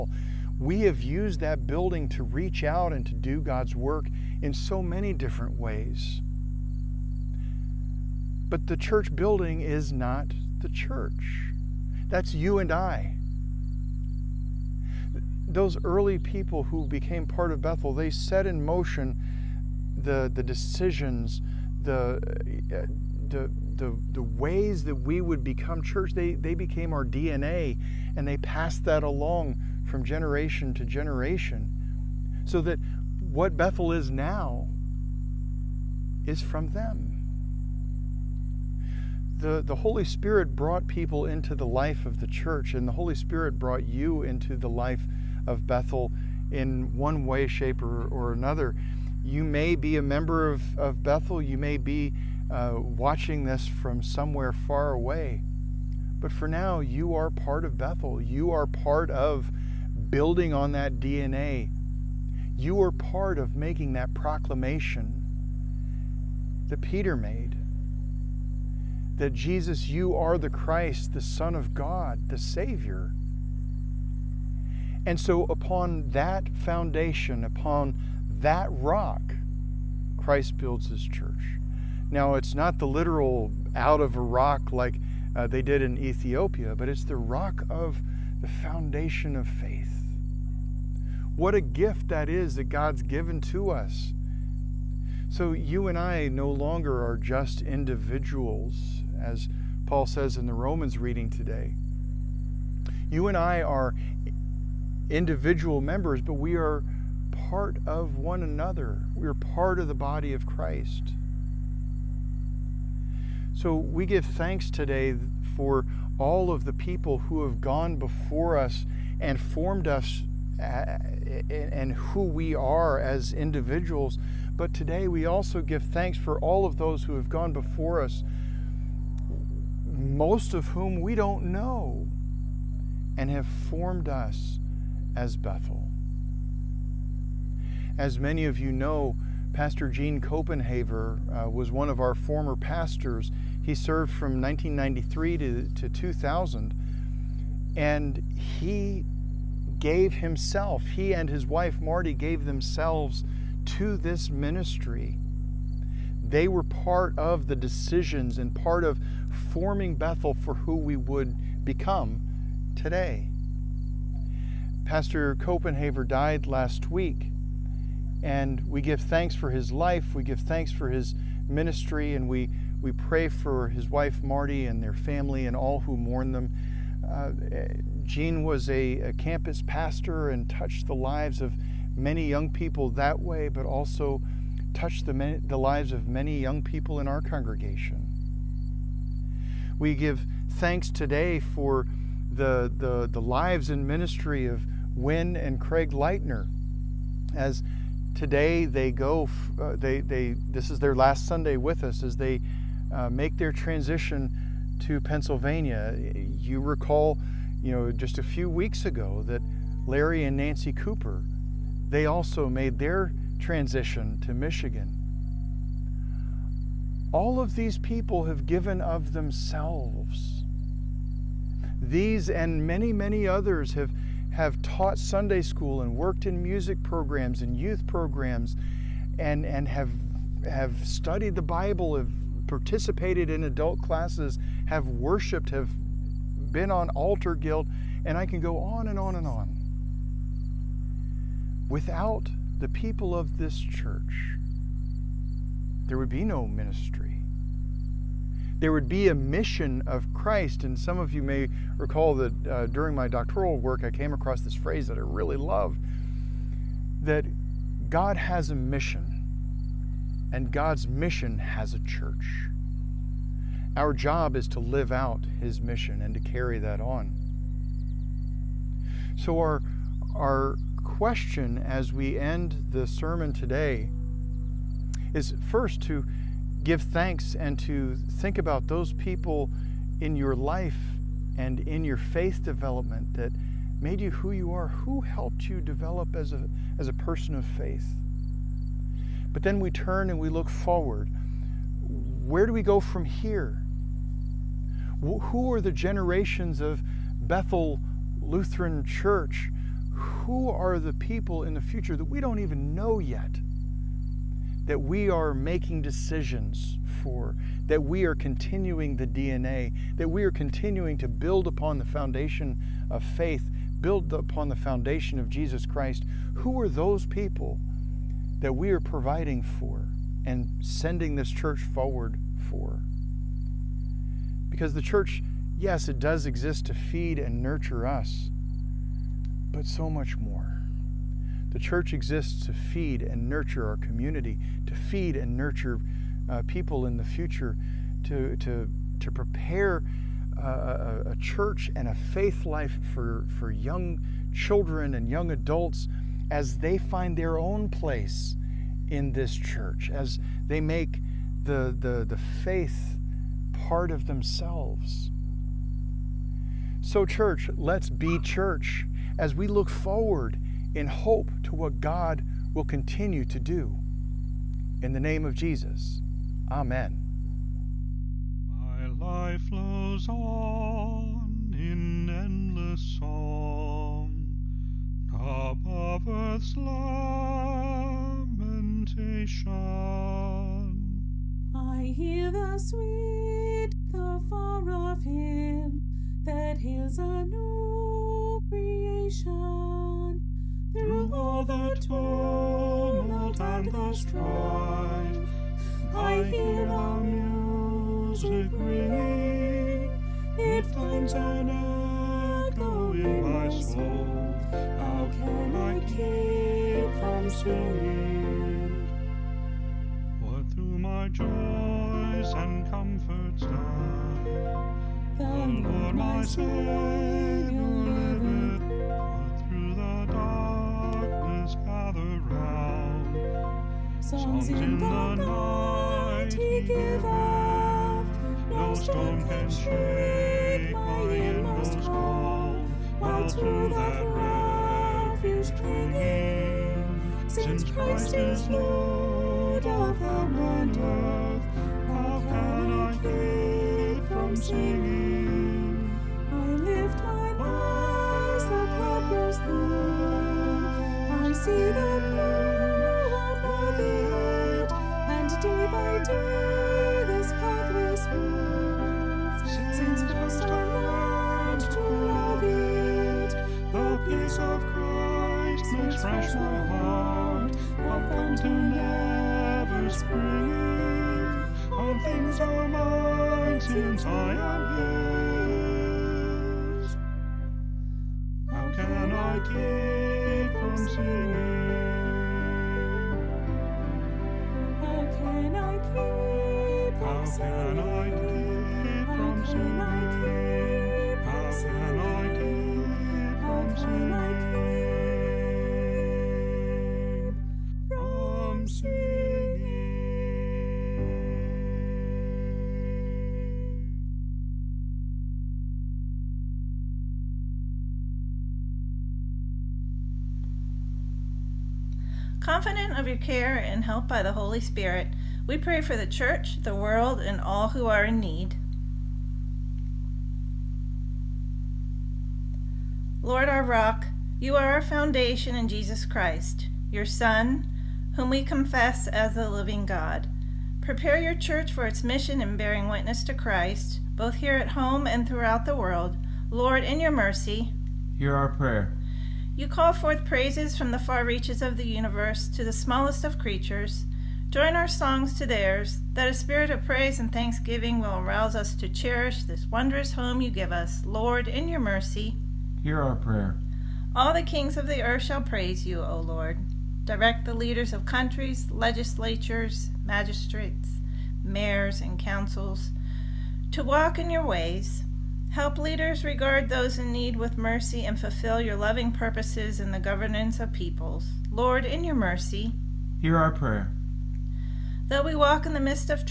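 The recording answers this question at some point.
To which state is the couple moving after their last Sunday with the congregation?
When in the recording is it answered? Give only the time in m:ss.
3:24.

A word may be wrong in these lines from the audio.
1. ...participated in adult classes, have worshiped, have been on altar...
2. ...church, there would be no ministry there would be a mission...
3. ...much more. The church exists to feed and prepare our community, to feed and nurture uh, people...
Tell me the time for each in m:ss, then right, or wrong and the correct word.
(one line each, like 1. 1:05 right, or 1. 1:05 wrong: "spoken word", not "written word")
1. 3:52 right
2. 4:03 right
3. 5:29 wrong: "nurture", not "prepare".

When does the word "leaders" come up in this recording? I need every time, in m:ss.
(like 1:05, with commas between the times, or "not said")
9:17, 9:25.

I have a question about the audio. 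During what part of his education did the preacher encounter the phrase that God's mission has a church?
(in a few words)
doctoral work.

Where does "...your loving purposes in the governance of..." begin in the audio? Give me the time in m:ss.
9:28.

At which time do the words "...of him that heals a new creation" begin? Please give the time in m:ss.
6:24.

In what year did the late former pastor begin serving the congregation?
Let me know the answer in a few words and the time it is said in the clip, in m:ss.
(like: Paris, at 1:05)
1993, at 2:24.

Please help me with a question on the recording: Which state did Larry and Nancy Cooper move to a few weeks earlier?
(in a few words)
Michigan.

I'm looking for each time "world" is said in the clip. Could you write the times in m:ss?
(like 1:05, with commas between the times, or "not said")
8:36, 8:55.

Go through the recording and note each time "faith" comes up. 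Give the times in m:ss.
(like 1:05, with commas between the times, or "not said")
1:29, 4:41, 4:47, 5:13, 5:41, 5:52.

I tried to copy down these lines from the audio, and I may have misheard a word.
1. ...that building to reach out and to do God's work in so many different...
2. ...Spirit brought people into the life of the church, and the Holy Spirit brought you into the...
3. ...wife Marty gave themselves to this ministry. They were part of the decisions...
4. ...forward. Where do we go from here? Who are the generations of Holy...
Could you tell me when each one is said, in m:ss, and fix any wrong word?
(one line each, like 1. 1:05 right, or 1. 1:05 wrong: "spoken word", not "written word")
1. 0:01 right
2. 0:40 right
3. 2:31 right
4. 4:50 wrong: "Bethel", not "Holy".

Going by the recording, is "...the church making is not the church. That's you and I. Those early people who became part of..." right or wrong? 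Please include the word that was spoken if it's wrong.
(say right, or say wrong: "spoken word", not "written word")
wrong: "building", not "making".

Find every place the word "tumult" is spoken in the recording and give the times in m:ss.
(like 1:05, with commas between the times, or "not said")
6:31.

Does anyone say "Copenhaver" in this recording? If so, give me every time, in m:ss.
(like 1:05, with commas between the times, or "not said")
2:20, 2:45.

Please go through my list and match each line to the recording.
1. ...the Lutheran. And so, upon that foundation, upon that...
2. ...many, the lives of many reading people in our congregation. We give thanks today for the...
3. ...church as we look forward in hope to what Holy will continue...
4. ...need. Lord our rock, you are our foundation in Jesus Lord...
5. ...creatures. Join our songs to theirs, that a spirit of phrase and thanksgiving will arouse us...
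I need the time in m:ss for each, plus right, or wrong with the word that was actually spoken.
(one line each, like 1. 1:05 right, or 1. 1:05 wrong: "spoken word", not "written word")
1. 1:12 wrong: "Savior", not "Lutheran"
2. 3:05 wrong: "young", not "reading"
3. 5:58 wrong: "God", not "Holy"
4. 8:38 wrong: "Christ", not "Lord"
5. 9:03 wrong: "praise", not "phrase".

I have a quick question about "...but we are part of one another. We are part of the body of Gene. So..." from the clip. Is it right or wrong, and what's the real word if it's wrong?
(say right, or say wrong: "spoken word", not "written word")
wrong: "Christ", not "Gene".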